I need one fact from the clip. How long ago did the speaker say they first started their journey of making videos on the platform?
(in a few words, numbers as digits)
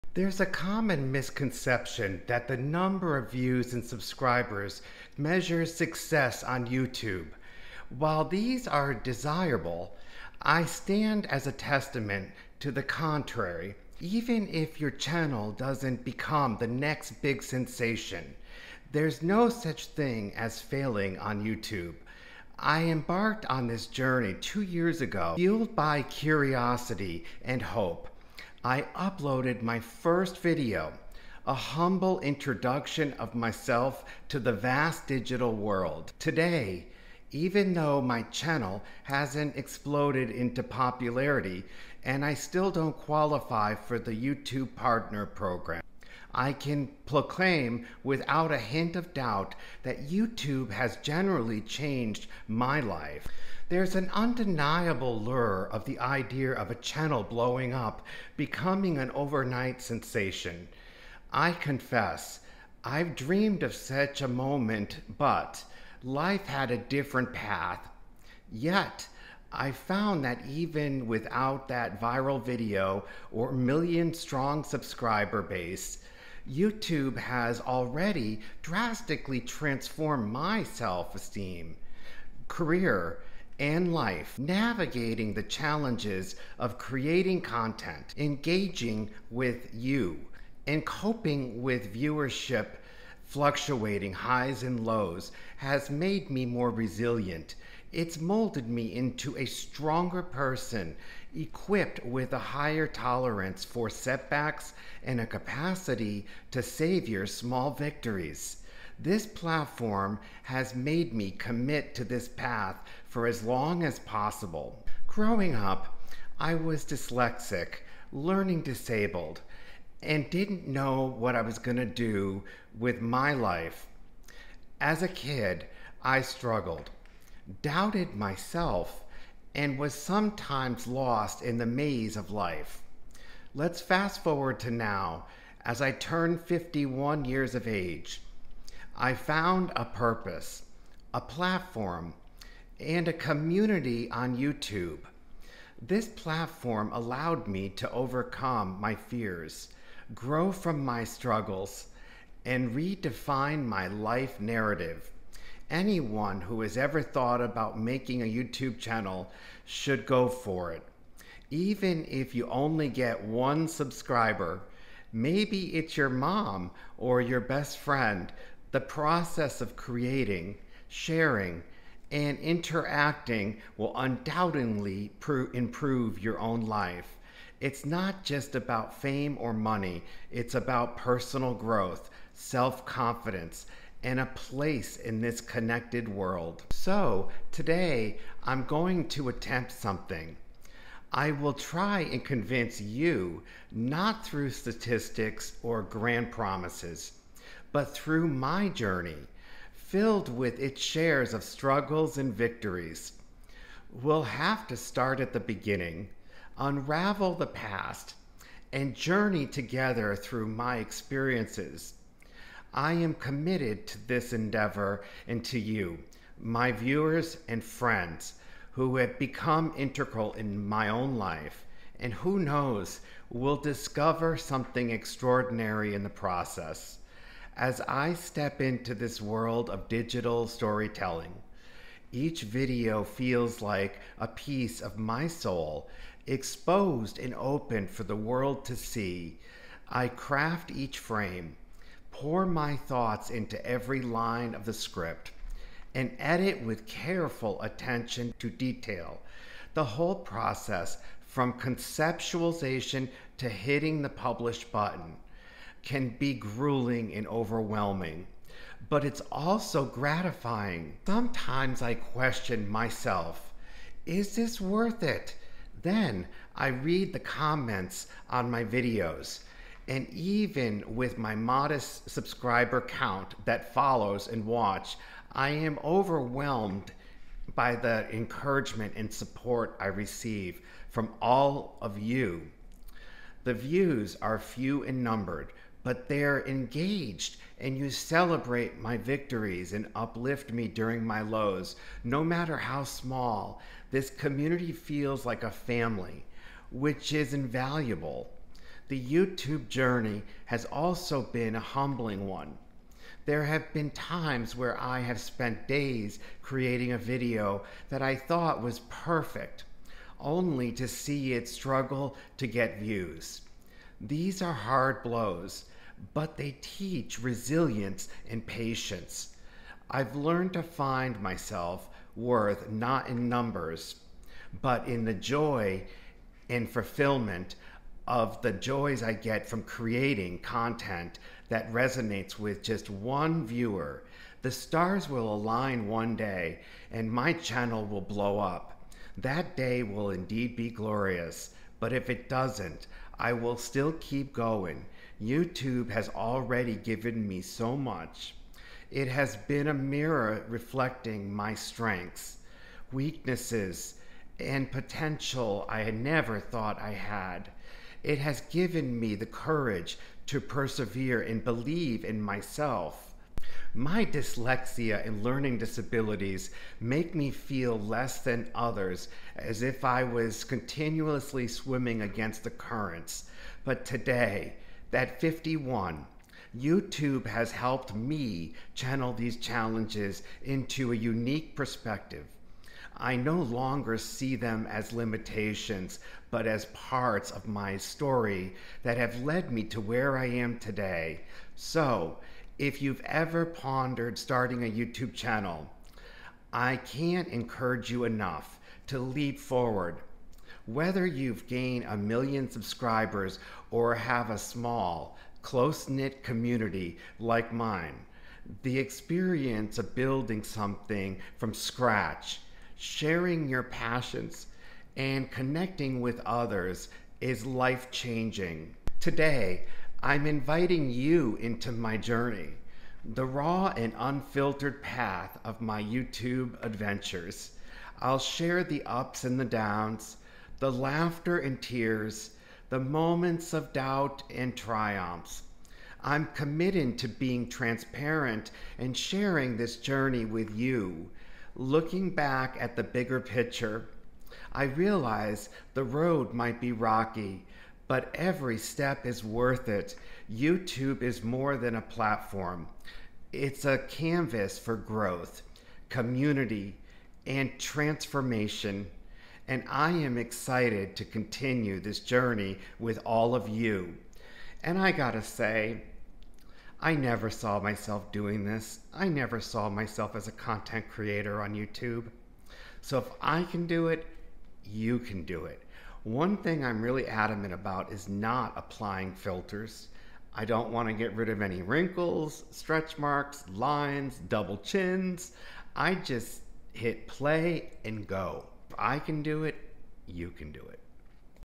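two years ago.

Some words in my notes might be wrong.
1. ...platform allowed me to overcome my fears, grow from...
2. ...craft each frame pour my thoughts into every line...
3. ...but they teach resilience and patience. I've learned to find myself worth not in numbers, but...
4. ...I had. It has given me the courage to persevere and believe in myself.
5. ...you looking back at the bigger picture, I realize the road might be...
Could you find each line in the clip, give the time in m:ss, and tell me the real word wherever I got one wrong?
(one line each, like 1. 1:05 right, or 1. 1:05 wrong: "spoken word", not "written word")
1. 2:26 right
2. 4:00 right
3. 5:16 right
4. 5:56 right
5. 7:20 right.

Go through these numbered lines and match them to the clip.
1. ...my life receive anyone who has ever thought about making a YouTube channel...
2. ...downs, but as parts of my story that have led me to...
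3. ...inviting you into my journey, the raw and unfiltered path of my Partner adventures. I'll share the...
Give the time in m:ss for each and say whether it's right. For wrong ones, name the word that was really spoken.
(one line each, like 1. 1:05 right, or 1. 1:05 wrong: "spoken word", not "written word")
1. 2:33 wrong: "narrative", not "receive"
2. 6:24 wrong: "limitations", not "downs"
3. 7:00 wrong: "YouTube", not "Partner".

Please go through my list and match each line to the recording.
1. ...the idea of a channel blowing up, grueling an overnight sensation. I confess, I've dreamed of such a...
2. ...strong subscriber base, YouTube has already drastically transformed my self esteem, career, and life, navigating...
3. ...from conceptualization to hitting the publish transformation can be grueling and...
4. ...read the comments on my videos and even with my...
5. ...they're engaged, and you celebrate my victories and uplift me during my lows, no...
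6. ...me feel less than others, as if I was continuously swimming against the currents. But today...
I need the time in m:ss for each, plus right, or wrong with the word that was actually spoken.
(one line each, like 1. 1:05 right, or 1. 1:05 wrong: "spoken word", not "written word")
1. 0:55 wrong: "becoming", not "grueling"
2. 1:14 right
3. 4:11 wrong: "button", not "transformation"
4. 4:26 right
5. 4:46 right
6. 6:07 right.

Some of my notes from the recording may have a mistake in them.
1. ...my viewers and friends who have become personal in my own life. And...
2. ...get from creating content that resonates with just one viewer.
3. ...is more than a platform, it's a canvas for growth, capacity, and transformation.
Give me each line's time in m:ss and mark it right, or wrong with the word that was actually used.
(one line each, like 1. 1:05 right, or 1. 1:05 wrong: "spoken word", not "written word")
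1. 3:36 wrong: "integral", not "personal"
2. 5:29 right
3. 7:31 wrong: "community", not "capacity".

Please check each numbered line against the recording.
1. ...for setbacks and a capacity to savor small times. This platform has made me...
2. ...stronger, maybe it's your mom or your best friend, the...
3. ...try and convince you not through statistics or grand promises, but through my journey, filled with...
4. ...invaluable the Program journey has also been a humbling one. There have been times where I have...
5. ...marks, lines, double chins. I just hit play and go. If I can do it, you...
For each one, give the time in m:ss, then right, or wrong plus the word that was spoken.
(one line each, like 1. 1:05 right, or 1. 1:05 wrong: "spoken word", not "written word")
1. 1:43 wrong: "victories", not "times"
2. 2:43 wrong: "subscriber", not "stronger"
3. 3:11 right
4. 4:57 wrong: "YouTube", not "Program"
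5. 8:02 right.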